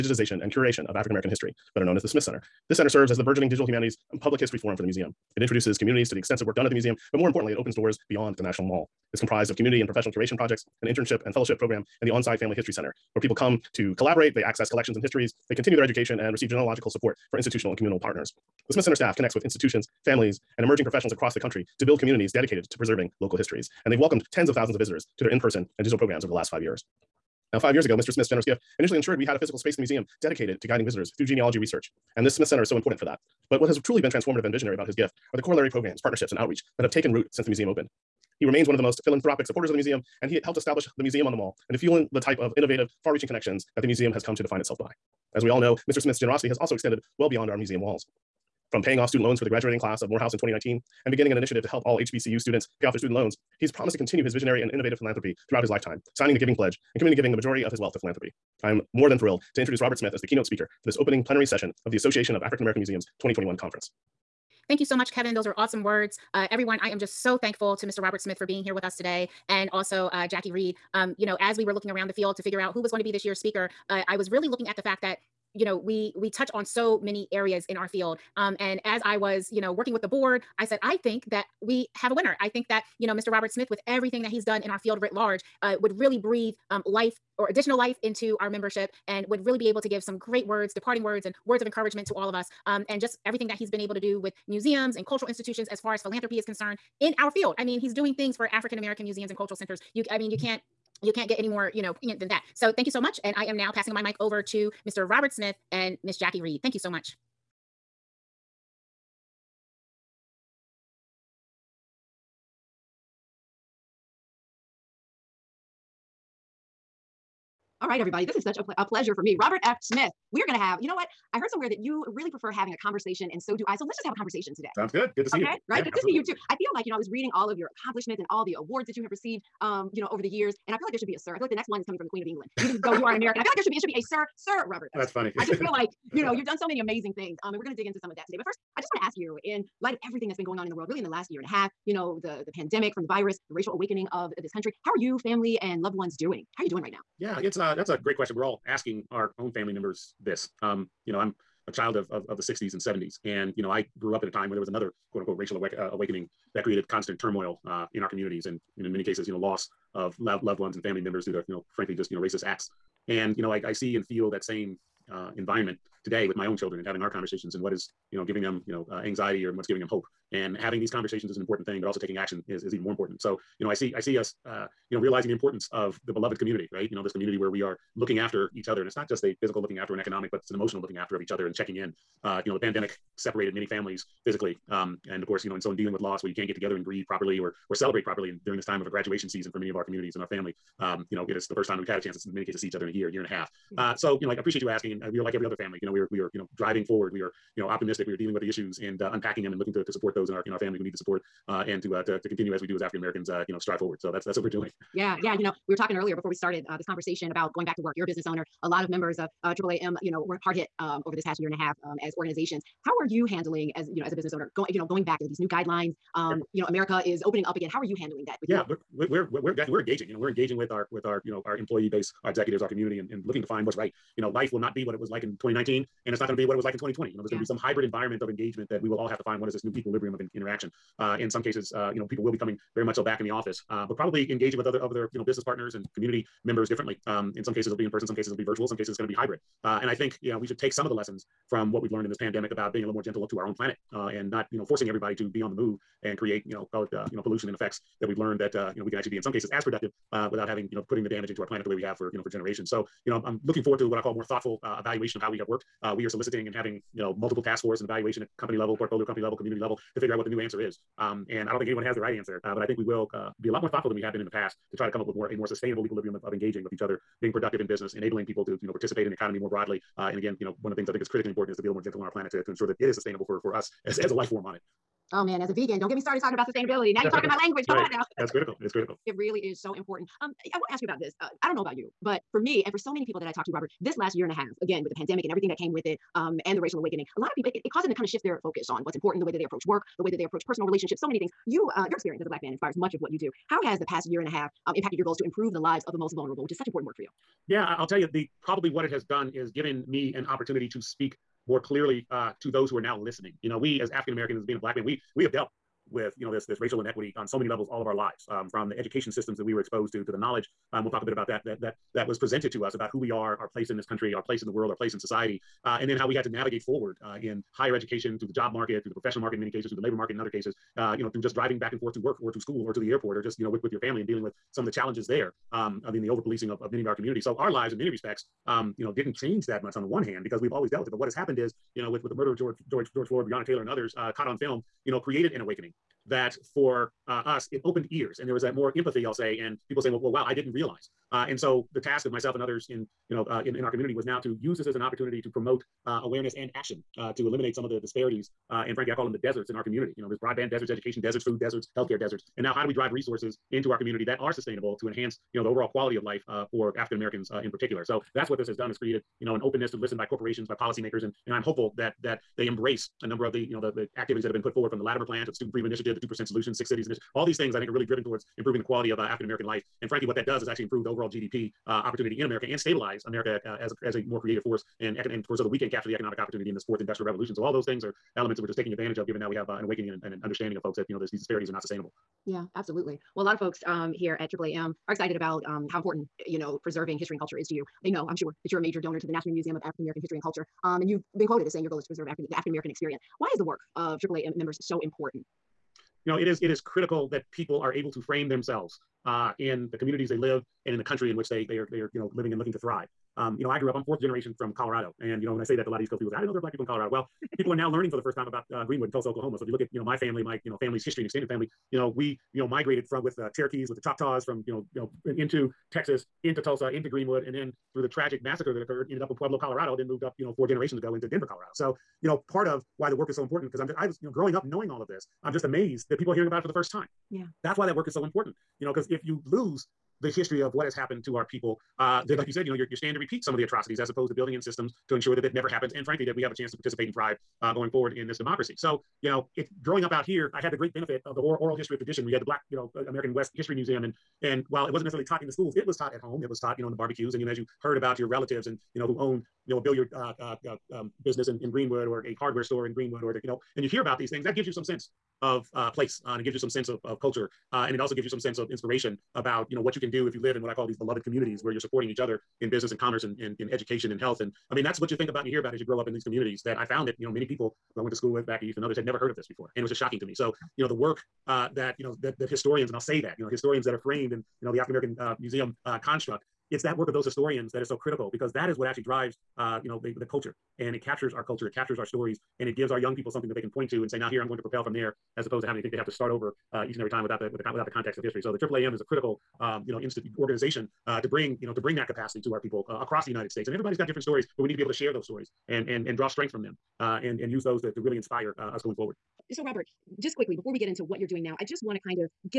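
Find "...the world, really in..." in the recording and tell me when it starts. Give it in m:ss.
2:20.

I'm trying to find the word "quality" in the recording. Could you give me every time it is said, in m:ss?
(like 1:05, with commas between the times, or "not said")
5:55, 6:08.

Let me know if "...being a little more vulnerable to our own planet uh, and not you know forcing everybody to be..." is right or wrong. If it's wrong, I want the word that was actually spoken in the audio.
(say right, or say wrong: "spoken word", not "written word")
wrong: "gentle", not "vulnerable".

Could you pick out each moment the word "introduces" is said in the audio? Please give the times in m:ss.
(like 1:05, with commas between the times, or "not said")
0:05, 0:59.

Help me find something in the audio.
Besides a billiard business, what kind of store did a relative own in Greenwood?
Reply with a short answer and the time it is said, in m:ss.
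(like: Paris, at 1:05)
hardware store, at 7:32.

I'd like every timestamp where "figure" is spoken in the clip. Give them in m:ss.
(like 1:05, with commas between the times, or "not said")
1:12, 4:19.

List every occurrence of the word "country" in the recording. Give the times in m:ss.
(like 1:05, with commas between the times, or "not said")
0:21, 2:24, 5:13, 6:40.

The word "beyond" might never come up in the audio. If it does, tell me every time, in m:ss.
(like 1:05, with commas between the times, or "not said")
0:08, 0:47.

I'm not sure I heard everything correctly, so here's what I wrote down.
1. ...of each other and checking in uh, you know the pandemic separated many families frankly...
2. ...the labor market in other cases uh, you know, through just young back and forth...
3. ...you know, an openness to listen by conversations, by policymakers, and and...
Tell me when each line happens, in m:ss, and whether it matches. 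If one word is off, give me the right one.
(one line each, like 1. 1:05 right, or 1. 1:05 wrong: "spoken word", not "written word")
1. 3:01 wrong: "physically", not "frankly"
2. 5:19 wrong: "driving", not "young"
3. 5:59 wrong: "corporations", not "conversations".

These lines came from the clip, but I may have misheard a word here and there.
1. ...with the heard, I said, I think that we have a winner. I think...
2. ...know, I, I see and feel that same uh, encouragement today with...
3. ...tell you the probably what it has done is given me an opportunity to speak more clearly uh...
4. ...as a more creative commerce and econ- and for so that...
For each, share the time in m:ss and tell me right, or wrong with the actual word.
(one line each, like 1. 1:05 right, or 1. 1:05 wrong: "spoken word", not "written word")
1. 1:19 wrong: "board", not "heard"
2. 2:43 wrong: "environment", not "encouragement"
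3. 4:57 right
4. 6:13 wrong: "force", not "commerce".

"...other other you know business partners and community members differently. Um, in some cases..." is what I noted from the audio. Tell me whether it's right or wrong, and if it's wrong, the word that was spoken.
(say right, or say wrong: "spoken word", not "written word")
right.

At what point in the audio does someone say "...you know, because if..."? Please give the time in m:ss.
7:08.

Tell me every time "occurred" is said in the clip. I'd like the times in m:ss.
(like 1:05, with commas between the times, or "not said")
6:58.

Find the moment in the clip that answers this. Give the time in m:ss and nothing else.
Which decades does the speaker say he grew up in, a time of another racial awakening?
2:32.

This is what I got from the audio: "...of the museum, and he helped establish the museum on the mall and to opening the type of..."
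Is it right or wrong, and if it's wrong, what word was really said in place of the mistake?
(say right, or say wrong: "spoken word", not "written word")
wrong: "fueling", not "opening".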